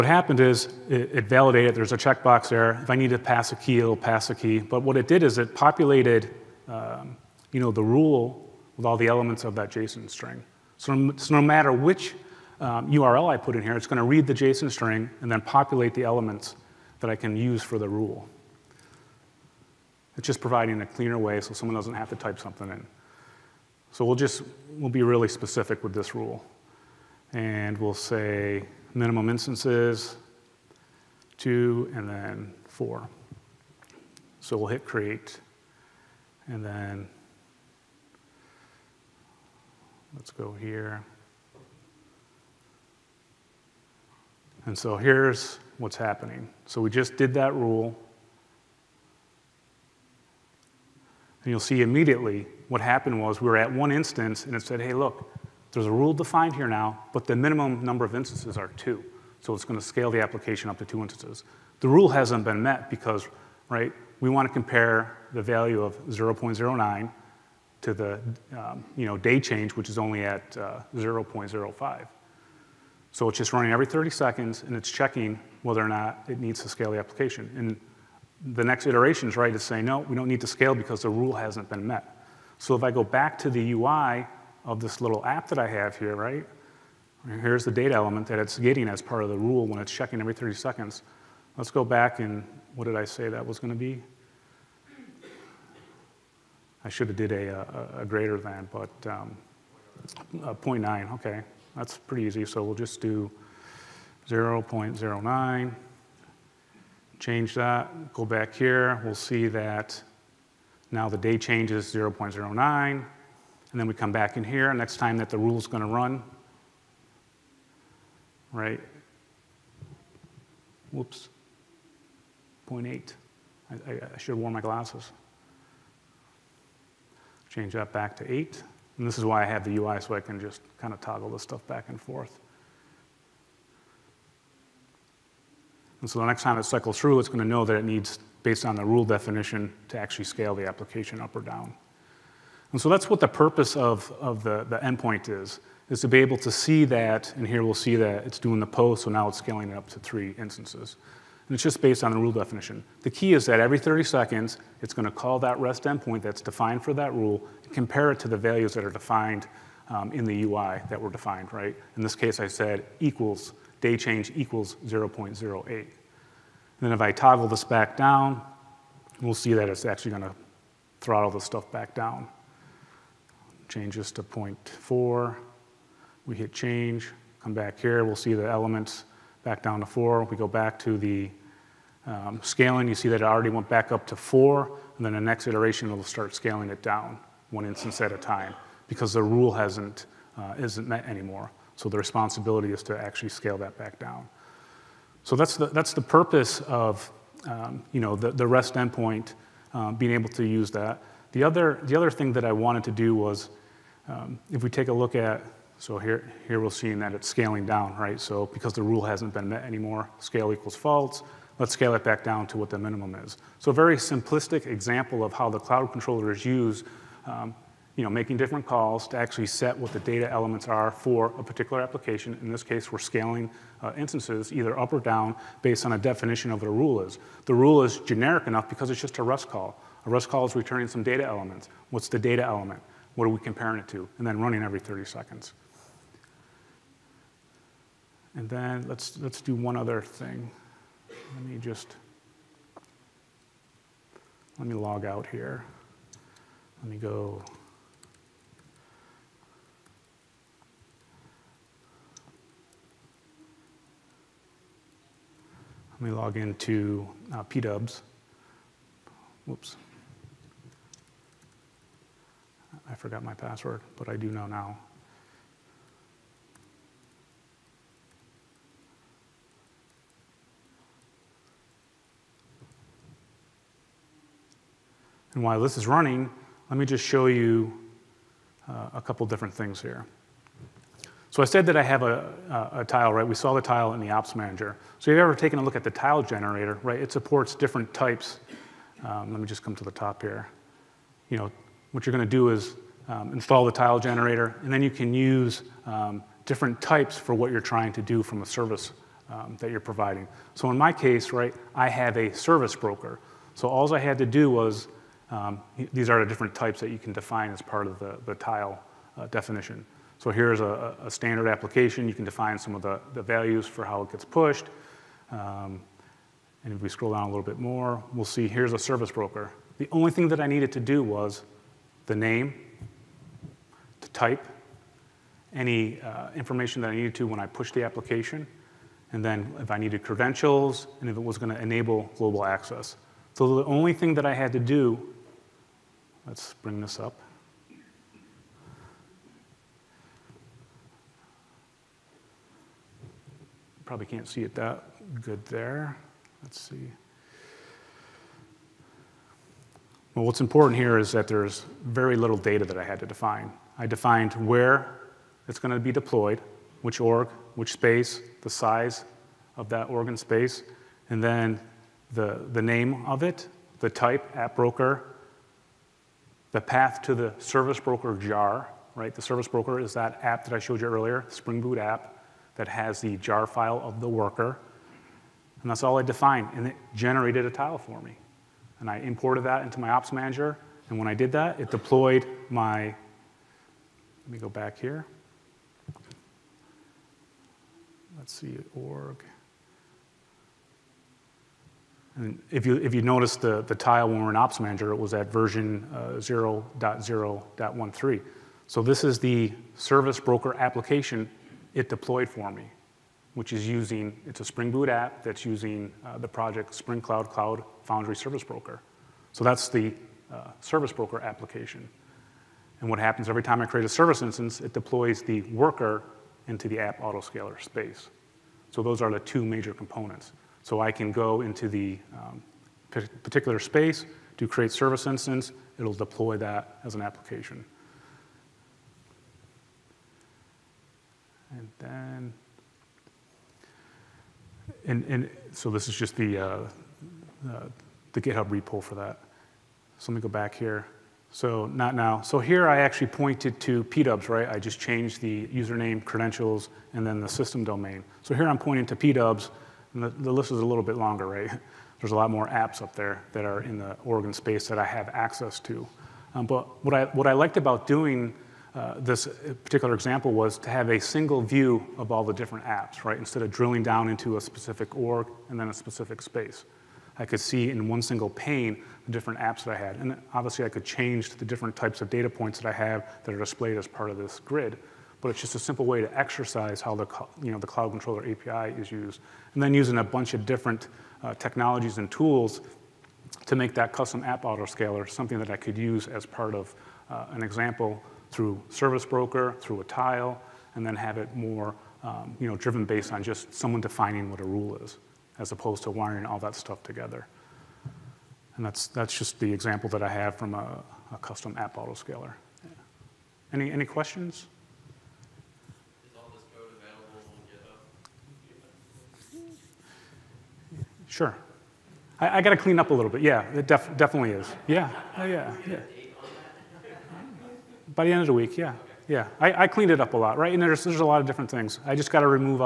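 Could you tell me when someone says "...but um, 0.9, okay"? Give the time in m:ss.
1:38.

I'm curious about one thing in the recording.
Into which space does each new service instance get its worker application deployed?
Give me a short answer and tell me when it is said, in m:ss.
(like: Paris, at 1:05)
app autoscaler space, at 6:56.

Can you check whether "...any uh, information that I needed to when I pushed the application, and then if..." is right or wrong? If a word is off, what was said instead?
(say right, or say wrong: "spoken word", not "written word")
right.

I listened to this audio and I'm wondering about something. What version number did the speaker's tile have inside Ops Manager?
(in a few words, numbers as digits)
0.0.13.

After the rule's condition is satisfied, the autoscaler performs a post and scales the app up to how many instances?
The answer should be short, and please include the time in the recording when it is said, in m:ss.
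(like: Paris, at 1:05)
3, at 2:29.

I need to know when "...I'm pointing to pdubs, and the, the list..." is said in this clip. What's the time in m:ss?
7:28.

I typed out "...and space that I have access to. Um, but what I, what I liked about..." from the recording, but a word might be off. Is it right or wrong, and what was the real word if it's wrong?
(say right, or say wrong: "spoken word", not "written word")
right.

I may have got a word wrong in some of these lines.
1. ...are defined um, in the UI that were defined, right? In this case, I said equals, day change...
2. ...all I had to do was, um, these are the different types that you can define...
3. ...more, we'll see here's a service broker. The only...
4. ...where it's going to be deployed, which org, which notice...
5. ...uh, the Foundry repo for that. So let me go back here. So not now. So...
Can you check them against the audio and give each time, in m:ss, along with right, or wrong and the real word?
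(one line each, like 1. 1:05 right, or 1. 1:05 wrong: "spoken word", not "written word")
1. 2:38 right
2. 5:03 right
3. 5:17 right
4. 5:54 wrong: "space", not "notice"
5. 7:16 wrong: "GitHub", not "Foundry".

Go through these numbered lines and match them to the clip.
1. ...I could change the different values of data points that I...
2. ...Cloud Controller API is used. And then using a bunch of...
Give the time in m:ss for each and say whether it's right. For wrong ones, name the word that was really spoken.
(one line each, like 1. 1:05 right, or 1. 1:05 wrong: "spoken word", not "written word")
1. 7:50 wrong: "types", not "values"
2. 7:57 right.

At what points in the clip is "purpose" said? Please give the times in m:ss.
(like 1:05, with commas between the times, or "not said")
2:23, 3:16.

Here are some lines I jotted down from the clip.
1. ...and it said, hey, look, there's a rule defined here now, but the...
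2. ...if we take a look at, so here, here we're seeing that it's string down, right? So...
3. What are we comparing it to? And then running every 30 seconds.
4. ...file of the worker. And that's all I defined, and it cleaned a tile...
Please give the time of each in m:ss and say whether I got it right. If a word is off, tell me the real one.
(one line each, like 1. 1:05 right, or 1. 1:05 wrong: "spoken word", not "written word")
1. 0:54 right
2. 3:24 wrong: "scaling", not "string"
3. 3:53 right
4. 6:13 wrong: "generated", not "cleaned".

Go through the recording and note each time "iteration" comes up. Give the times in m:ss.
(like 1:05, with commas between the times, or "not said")
1:18, 3:05.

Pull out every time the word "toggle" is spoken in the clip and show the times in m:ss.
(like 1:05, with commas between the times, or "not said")
2:10, 2:47.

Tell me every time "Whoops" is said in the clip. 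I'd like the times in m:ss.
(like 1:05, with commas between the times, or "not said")
2:00, 4:19.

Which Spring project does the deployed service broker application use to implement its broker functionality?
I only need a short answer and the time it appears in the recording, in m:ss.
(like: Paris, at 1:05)
Spring Cloud Cloud Foundry Service Broker, at 6:46.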